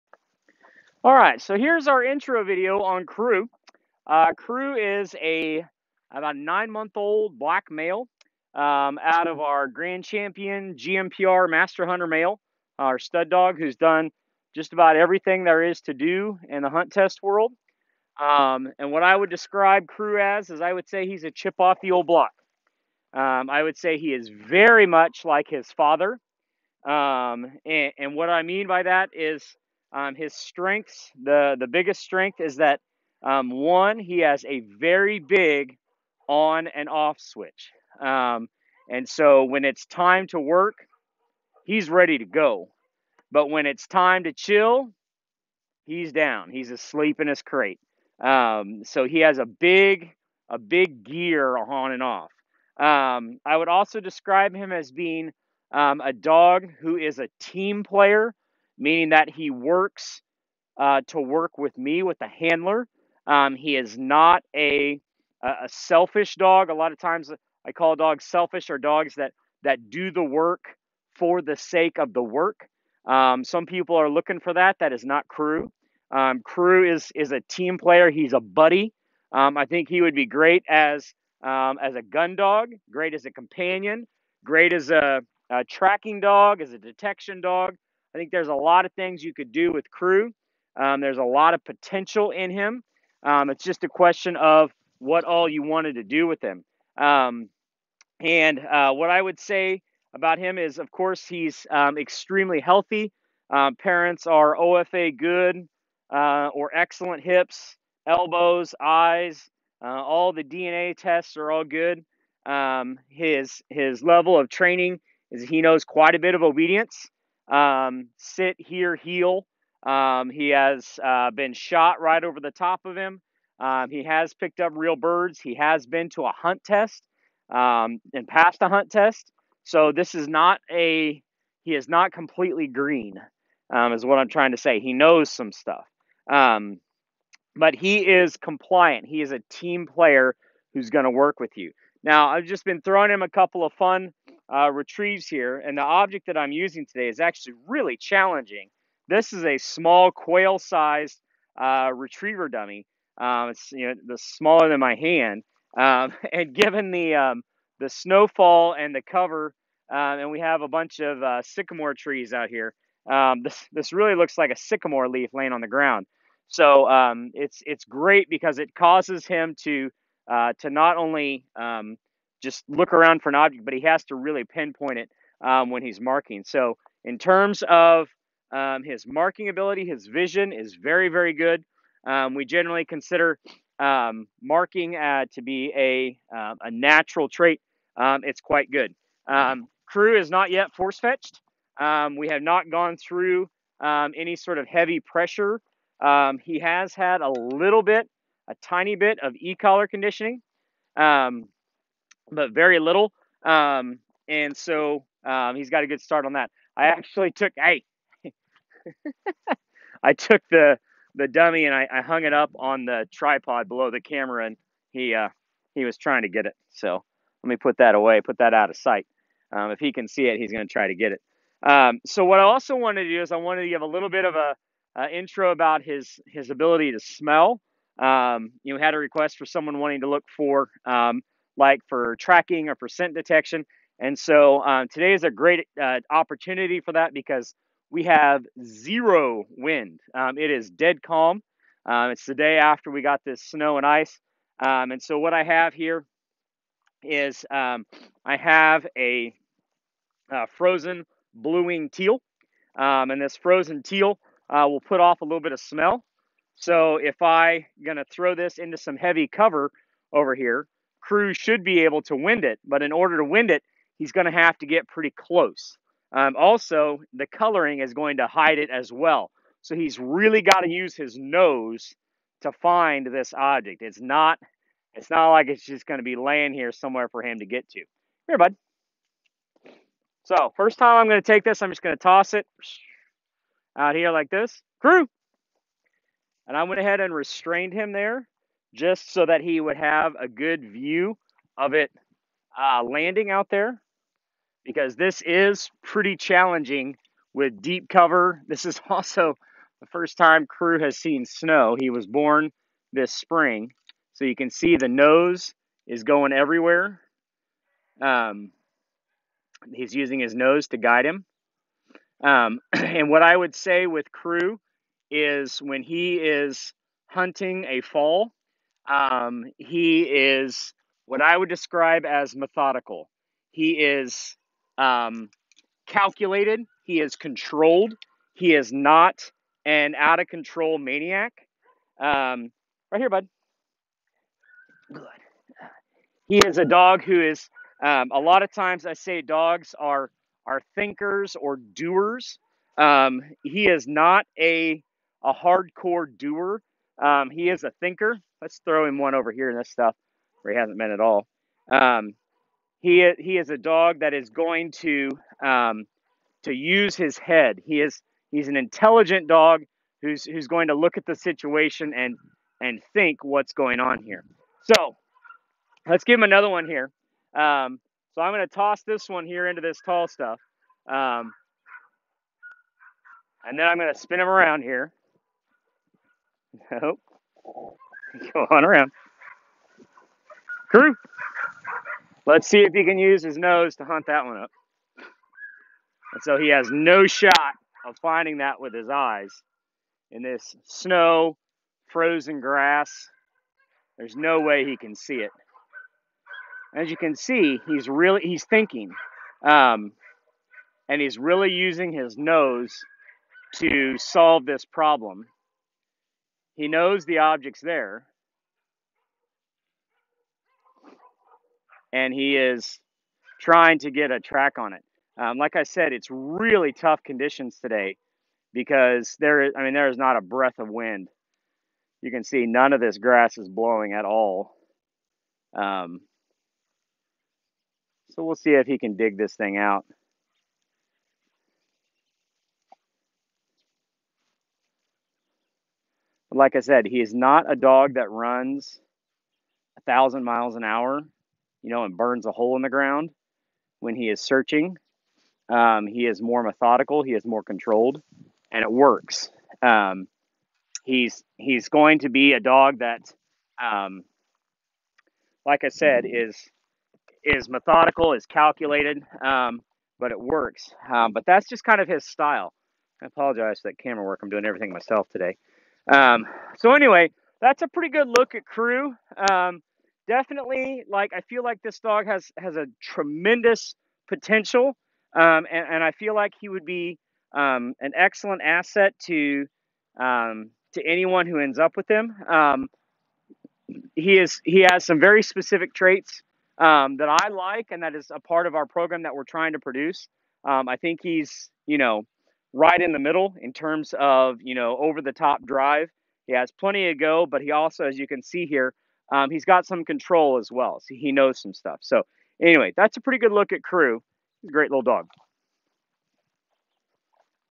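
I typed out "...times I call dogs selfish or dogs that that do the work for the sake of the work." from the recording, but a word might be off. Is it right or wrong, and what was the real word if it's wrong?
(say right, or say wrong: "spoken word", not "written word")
right.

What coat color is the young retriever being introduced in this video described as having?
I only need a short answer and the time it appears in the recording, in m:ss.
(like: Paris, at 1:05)
Black, at 0:07.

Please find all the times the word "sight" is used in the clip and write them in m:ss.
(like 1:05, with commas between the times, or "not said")
3:38.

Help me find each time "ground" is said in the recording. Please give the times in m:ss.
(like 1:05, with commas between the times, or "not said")
2:45, 7:22.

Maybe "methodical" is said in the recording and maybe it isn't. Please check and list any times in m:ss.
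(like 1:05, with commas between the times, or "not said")
5:22, 7:26, 7:37.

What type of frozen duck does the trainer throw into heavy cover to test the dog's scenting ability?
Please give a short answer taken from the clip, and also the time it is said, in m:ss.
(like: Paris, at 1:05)
Blue-wing teal, at 4:11.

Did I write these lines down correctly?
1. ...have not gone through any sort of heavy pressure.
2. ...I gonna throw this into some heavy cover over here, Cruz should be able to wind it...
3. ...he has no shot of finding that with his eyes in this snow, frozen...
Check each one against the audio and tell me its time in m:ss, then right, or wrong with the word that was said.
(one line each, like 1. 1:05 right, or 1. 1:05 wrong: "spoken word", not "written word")
1. 3:12 right
2. 4:17 right
3. 6:26 right.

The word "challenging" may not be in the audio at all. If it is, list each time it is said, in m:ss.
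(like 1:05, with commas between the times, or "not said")
2:27, 4:56.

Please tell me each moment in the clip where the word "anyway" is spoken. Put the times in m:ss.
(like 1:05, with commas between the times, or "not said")
7:46, 8:22.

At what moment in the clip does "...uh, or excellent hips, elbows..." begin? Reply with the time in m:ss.
1:46.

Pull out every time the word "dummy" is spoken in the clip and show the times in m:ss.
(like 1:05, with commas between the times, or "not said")
2:32, 3:31.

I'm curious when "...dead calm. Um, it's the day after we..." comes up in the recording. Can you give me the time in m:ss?
4:00.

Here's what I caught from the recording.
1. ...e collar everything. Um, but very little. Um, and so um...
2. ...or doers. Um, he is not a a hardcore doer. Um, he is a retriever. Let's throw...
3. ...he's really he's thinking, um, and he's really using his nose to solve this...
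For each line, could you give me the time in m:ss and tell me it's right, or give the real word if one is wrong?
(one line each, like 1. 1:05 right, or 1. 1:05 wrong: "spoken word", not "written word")
1. 3:19 wrong: "conditioning", not "everything"
2. 5:41 wrong: "thinker", not "retriever"
3. 6:37 right.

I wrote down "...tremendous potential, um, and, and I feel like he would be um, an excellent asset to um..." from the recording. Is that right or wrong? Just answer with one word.
right.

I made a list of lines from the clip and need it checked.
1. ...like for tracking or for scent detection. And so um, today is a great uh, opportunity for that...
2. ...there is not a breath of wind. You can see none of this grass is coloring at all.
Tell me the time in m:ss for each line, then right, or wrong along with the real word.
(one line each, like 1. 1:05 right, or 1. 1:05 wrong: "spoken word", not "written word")
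1. 3:51 right
2. 6:59 wrong: "blowing", not "coloring".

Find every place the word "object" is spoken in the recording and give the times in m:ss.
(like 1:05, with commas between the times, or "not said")
2:25, 2:53, 4:33, 6:47.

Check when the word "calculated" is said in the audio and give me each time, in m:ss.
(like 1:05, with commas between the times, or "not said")
5:25, 7:38.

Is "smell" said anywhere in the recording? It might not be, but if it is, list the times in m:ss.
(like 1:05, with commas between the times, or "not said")
3:46, 4:15.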